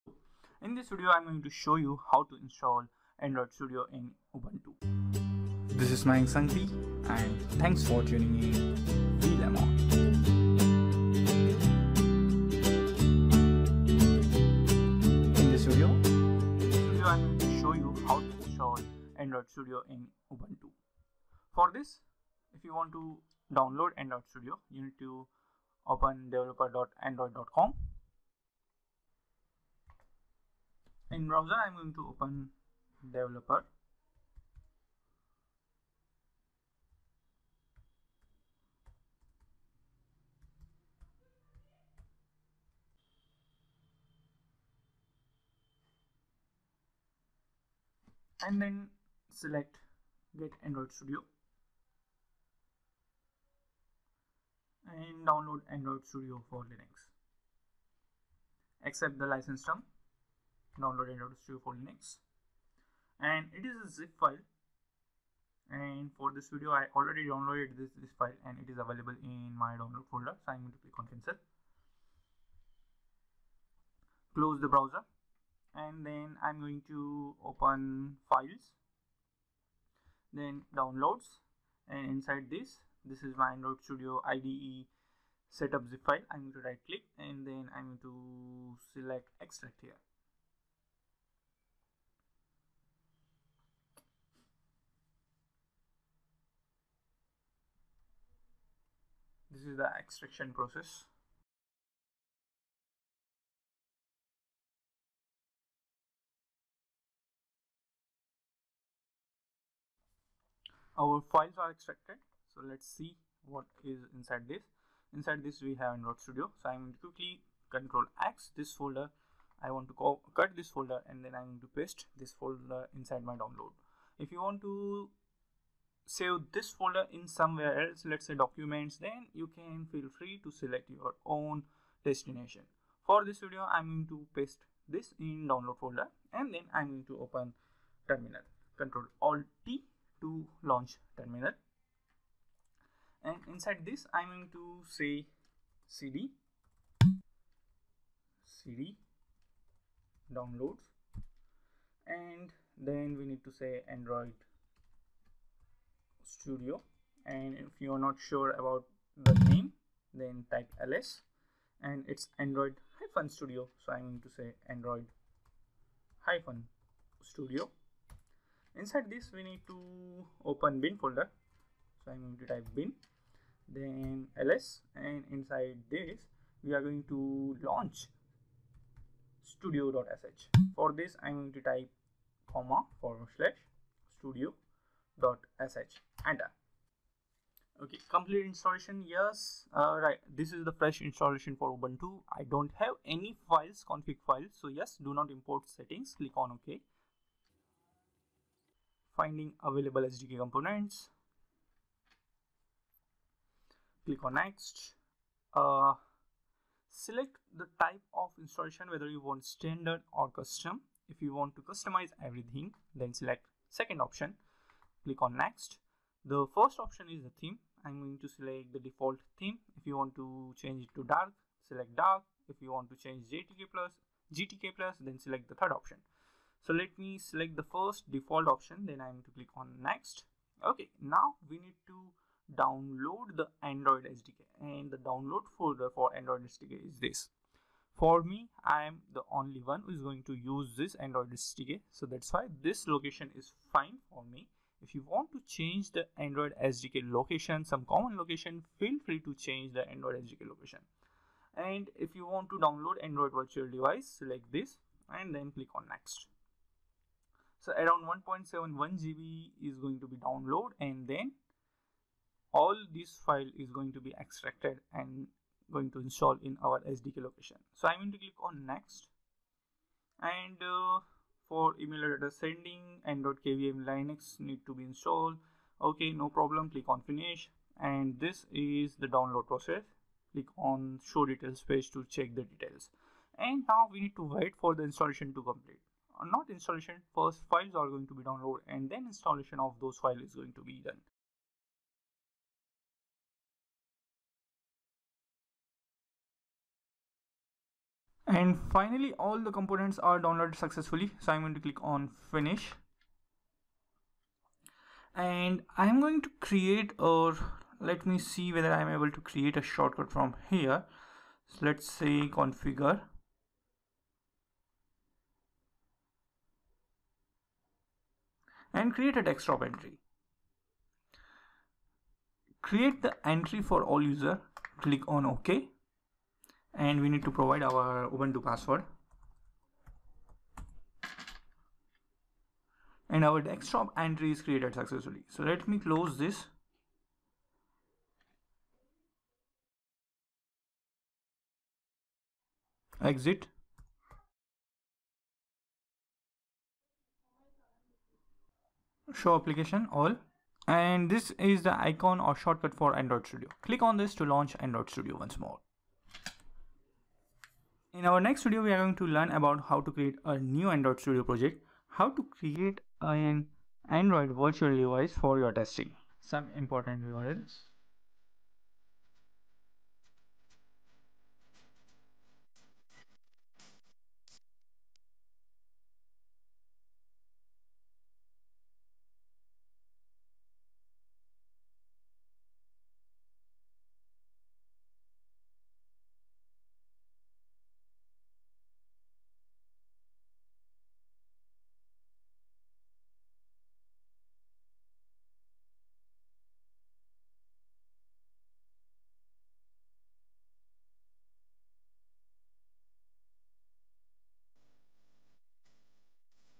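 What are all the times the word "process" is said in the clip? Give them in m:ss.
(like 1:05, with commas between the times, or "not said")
1:40, 4:39.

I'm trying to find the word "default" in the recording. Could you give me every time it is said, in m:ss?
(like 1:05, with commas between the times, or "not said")
3:38, 3:48.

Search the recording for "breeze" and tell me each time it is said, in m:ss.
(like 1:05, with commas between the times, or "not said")
not said.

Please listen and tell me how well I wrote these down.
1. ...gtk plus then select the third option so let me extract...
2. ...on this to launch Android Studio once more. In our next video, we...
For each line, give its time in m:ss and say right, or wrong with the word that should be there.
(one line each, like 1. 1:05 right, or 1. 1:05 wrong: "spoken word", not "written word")
1. 3:44 wrong: "select", not "extract"
2. 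5:53 right.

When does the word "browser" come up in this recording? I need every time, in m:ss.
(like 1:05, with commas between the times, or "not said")
0:31, 1:14.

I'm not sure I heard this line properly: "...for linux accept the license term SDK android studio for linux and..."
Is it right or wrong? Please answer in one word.
wrong.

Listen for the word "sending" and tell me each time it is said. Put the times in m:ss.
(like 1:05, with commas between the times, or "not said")
4:32.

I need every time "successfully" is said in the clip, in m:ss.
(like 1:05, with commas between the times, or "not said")
5:00, 5:34.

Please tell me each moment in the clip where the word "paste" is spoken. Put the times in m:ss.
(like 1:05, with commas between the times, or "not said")
2:01, 2:14.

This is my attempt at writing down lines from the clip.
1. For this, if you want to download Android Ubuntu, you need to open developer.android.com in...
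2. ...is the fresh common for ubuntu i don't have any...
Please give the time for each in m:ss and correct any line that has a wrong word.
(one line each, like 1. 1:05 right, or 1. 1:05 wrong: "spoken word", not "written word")
1. 0:21 wrong: "Studio", not "Ubuntu"
2. 3:10 wrong: "installation", not "common".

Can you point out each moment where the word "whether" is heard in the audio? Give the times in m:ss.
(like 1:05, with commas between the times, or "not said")
3:28, 5:08.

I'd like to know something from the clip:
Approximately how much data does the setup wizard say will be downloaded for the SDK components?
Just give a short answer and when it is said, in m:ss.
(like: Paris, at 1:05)
1.71 GB, at 4:18.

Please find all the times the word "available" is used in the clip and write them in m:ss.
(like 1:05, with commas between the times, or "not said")
1:08, 3:19.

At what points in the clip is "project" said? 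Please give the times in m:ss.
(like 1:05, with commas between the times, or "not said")
6:01.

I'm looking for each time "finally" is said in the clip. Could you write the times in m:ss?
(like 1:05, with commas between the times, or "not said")
4:58.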